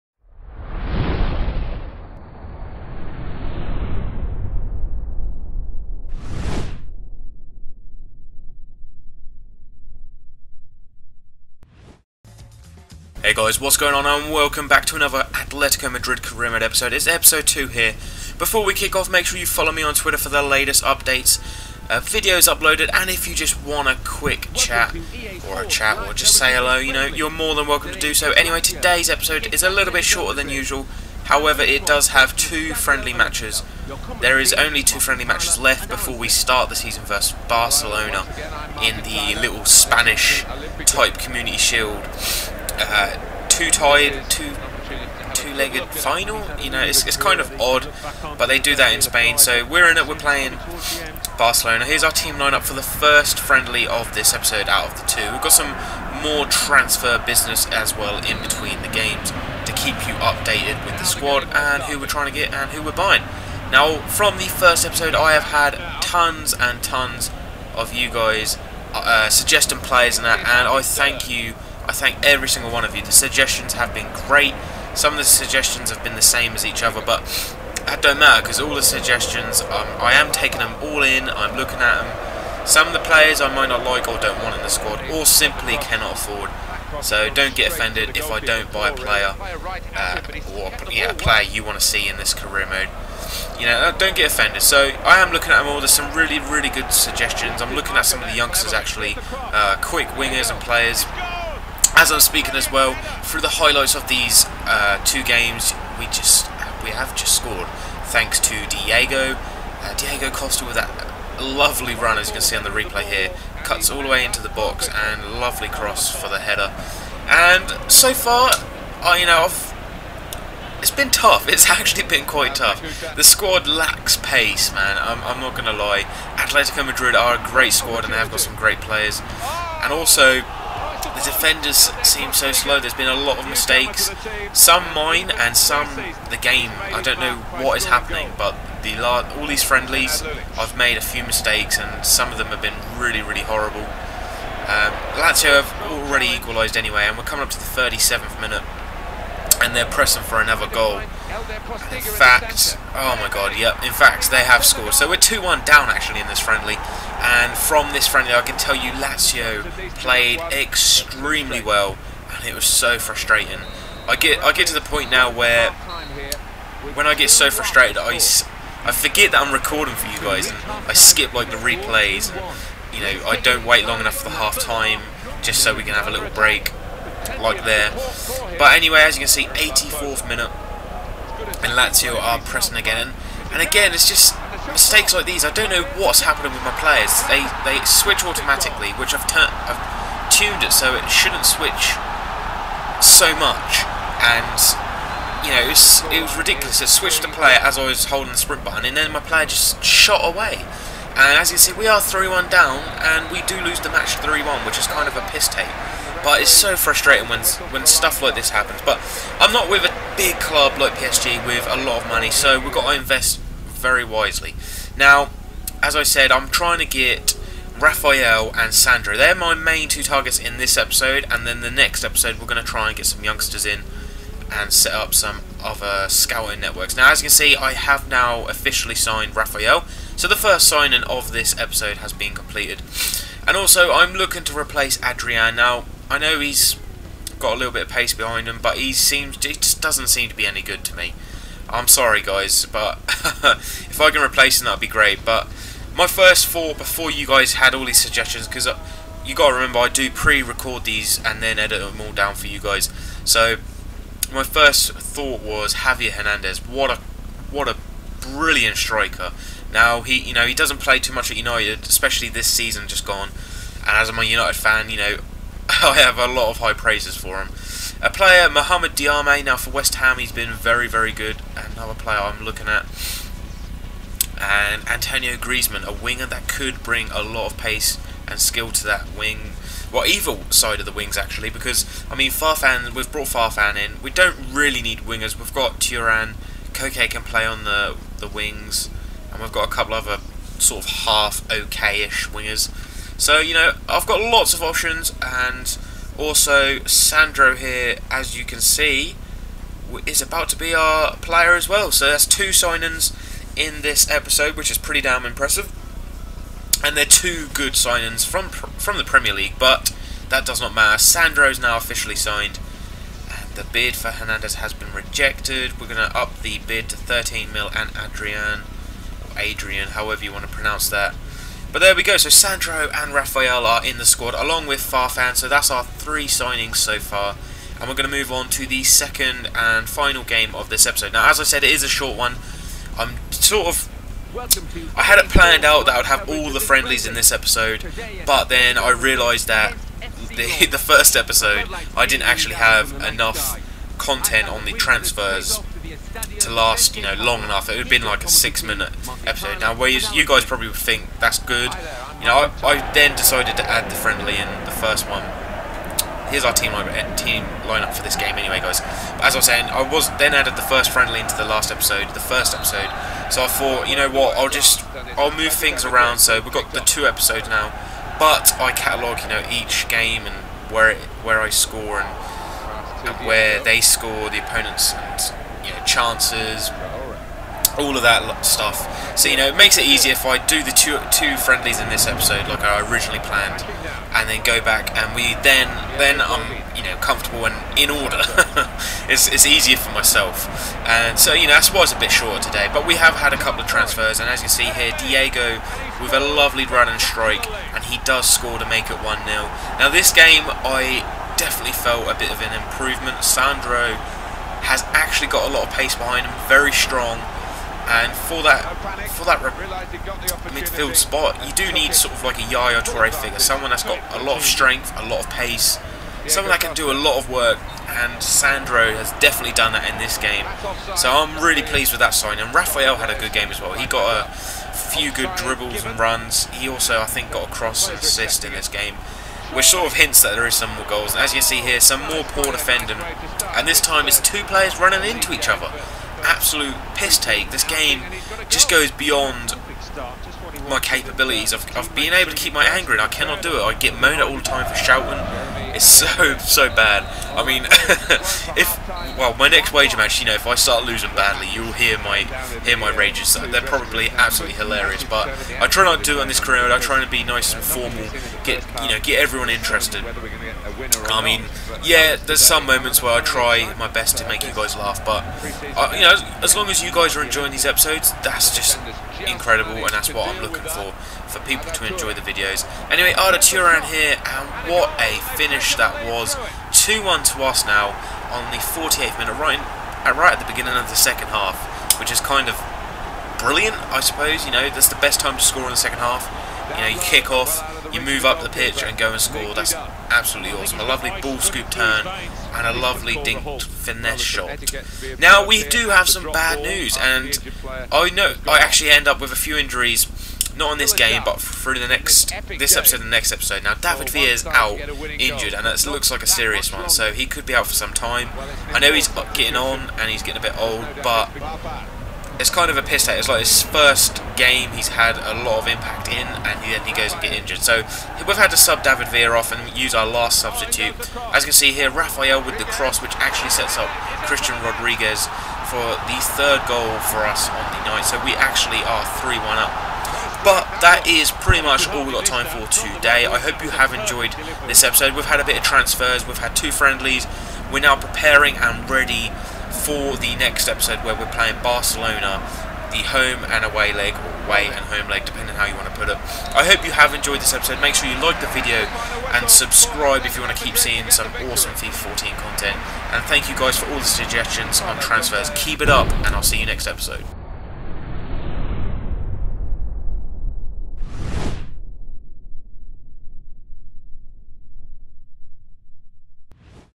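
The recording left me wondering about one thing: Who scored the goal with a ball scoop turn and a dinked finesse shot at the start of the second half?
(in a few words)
Arda Turan.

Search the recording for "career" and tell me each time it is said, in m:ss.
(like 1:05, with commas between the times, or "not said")
0:16, 1:32, 7:36.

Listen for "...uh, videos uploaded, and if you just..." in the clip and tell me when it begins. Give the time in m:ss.
0:21.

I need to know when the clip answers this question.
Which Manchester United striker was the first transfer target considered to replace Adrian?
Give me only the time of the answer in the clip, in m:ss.
4:15.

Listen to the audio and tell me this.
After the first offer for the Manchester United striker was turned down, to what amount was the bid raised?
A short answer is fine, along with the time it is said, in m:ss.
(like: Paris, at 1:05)
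13 million, at 5:16.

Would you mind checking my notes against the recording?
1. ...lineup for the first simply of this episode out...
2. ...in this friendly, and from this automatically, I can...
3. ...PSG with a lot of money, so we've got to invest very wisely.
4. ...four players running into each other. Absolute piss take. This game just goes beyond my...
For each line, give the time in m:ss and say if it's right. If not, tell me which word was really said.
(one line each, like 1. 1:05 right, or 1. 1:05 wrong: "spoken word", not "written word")
1. 0:52 wrong: "friendly", not "simply"
2. 2:36 wrong: "friendly", not "automatically"
3. 3:30 right
4. 7:14 wrong: "two", not "four".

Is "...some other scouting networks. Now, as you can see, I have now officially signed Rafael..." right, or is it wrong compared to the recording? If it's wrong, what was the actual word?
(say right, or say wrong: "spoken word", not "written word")
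right.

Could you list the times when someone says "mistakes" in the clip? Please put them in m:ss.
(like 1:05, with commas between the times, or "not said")
2:13, 2:21, 3:04.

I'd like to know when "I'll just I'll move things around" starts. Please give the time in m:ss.
6:04.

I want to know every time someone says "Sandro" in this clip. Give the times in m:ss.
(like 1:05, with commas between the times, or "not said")
3:38, 4:56, 5:10, 5:22, 6:43, 6:58.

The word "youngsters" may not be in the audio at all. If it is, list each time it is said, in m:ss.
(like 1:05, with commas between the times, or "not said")
1:38, 3:43.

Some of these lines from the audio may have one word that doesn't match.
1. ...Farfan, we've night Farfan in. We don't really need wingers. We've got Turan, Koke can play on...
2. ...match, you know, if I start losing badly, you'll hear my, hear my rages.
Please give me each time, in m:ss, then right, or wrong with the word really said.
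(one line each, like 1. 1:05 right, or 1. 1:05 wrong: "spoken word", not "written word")
1. 4:42 wrong: "brought", not "night"
2. 7:29 right.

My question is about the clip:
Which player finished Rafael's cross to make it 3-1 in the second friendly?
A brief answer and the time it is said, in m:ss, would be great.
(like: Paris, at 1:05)
Cristian Rodriguez, at 8:44.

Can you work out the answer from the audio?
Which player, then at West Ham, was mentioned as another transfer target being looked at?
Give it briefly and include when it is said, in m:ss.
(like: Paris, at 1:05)
Mohamed Diame, at 4:28.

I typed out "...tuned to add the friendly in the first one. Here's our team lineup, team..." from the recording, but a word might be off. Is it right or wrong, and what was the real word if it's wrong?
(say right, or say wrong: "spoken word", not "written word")
wrong: "decided", not "tuned".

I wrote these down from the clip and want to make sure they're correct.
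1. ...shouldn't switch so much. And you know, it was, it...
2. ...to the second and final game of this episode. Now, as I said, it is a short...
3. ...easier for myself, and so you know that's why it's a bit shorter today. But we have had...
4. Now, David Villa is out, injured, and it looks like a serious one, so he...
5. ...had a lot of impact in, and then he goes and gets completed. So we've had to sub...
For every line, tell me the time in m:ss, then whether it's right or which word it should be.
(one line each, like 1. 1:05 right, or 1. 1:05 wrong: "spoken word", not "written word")
1. 3:11 right
2. 5:28 right
3. 6:29 right
4. 8:23 right
5. 8:34 wrong: "injured", not "completed".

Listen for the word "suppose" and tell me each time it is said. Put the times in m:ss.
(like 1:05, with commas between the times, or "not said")
8:04.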